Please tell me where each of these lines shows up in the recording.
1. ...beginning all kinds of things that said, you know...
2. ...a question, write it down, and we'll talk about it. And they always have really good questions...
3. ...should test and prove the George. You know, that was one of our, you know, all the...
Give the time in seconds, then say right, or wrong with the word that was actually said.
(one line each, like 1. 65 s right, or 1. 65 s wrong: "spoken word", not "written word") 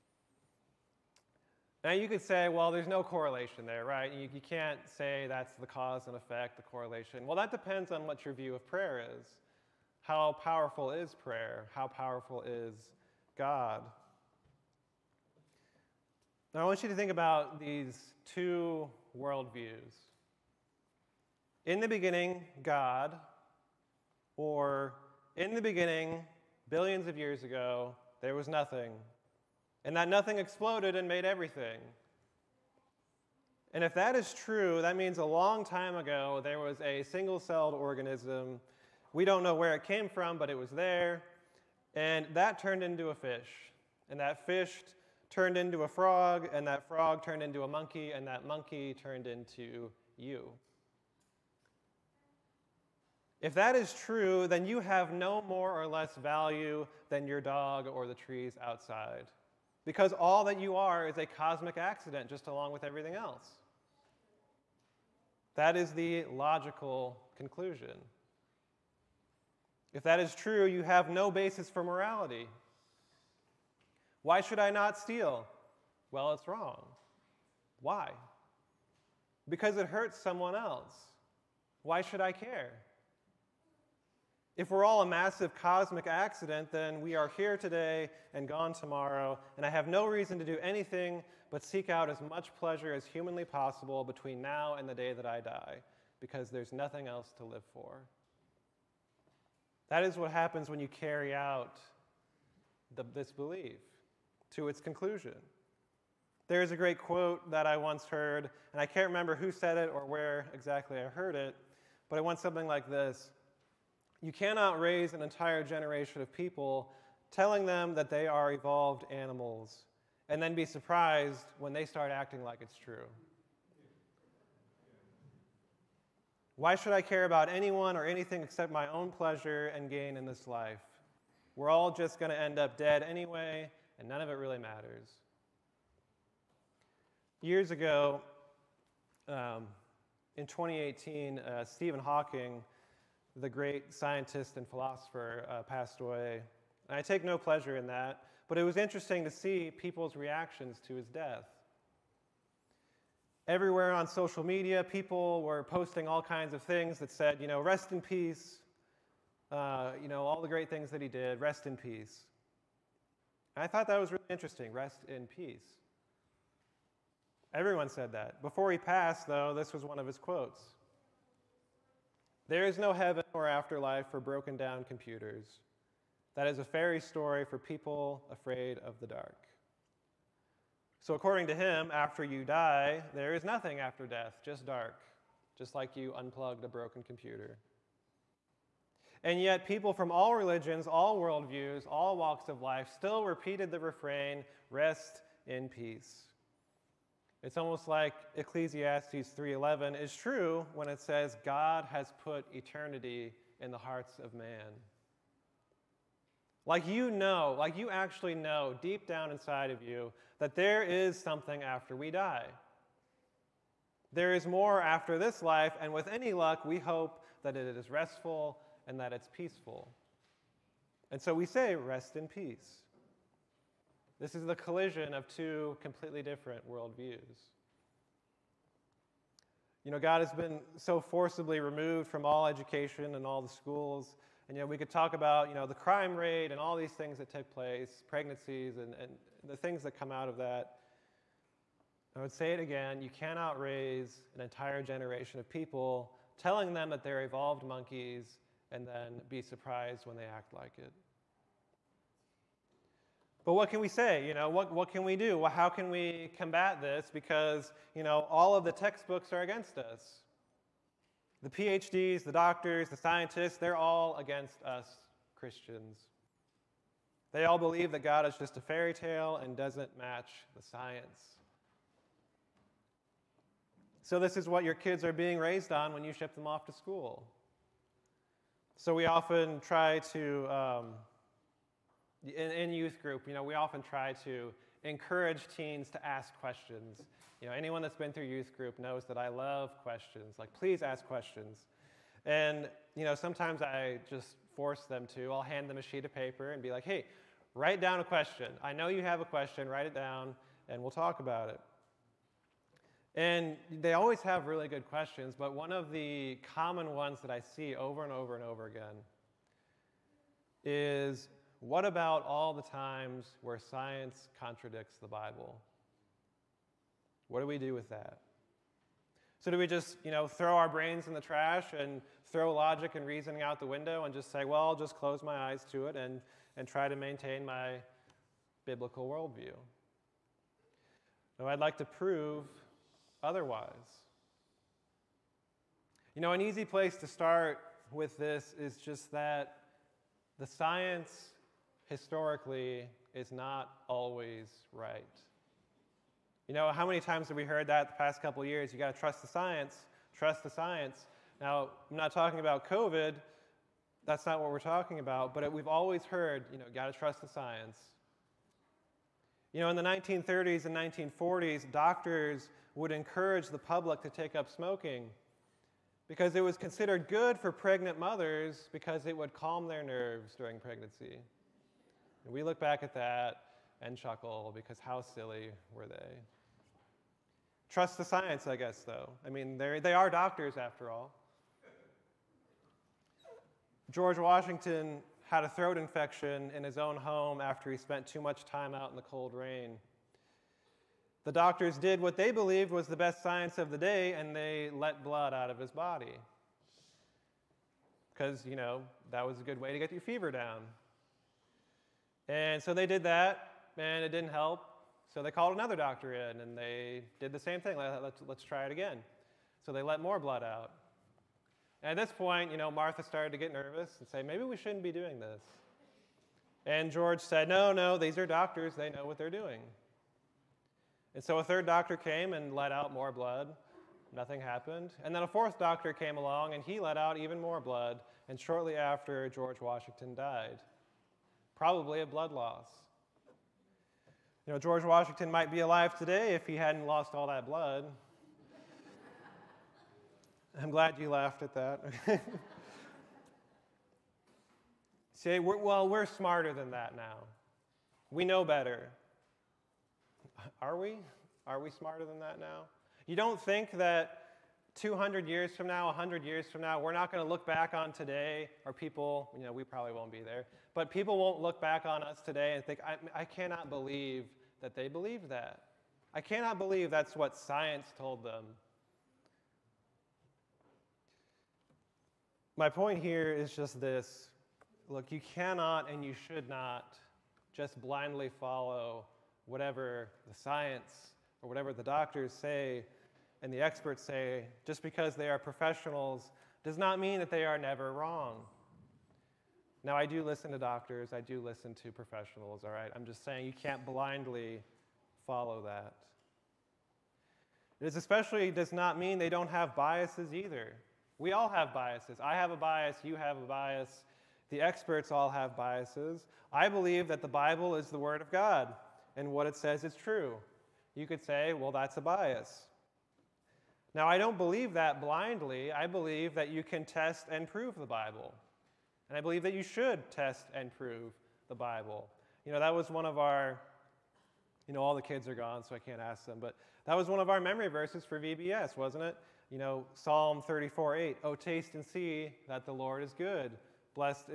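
1. 155 s wrong: "posting", not "beginning"
2. 299 s right
3. 519 s wrong: "Bible", not "George".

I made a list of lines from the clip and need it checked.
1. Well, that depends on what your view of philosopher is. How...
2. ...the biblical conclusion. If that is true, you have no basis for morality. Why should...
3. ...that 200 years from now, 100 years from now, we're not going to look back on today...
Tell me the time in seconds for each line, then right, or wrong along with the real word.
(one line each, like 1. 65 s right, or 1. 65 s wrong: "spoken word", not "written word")
1. 7 s wrong: "prayer", not "philosopher"
2. 65 s wrong: "logical", not "biblical"
3. 453 s right.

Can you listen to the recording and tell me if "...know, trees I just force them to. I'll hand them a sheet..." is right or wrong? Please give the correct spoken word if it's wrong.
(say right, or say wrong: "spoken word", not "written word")
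wrong: "sometimes", not "trees".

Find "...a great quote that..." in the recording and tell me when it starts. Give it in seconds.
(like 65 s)
106 s.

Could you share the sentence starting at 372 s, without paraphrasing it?
And we look back at that and chuckle because how silly were they?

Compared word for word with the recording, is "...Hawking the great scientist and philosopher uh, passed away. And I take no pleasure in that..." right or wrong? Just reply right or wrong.
right.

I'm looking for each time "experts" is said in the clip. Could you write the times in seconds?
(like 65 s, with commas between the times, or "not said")
483 s, 504 s.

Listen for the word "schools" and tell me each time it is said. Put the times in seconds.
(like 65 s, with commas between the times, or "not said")
233 s, 276 s.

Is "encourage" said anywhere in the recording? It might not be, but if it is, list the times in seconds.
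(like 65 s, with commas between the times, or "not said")
284 s, 362 s.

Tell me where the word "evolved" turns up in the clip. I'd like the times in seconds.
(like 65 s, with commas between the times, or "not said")
118 s, 247 s.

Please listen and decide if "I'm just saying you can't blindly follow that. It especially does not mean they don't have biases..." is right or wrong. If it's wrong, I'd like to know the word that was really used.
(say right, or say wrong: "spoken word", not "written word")
right.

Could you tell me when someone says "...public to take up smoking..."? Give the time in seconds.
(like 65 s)
363 s.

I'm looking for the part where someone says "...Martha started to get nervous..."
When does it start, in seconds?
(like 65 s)
412 s.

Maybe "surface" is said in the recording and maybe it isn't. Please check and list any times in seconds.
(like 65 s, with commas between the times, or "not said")
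not said.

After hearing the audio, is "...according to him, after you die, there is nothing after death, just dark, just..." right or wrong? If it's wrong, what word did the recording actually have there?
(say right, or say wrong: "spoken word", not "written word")
right.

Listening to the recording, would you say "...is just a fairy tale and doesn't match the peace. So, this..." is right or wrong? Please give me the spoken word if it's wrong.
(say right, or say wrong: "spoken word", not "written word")
wrong: "science", not "peace".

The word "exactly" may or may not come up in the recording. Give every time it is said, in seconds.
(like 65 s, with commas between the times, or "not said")
110 s.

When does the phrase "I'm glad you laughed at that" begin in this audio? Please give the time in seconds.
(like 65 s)
440 s.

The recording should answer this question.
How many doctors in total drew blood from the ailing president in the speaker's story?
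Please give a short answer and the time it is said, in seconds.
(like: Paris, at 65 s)
4, at 425 s.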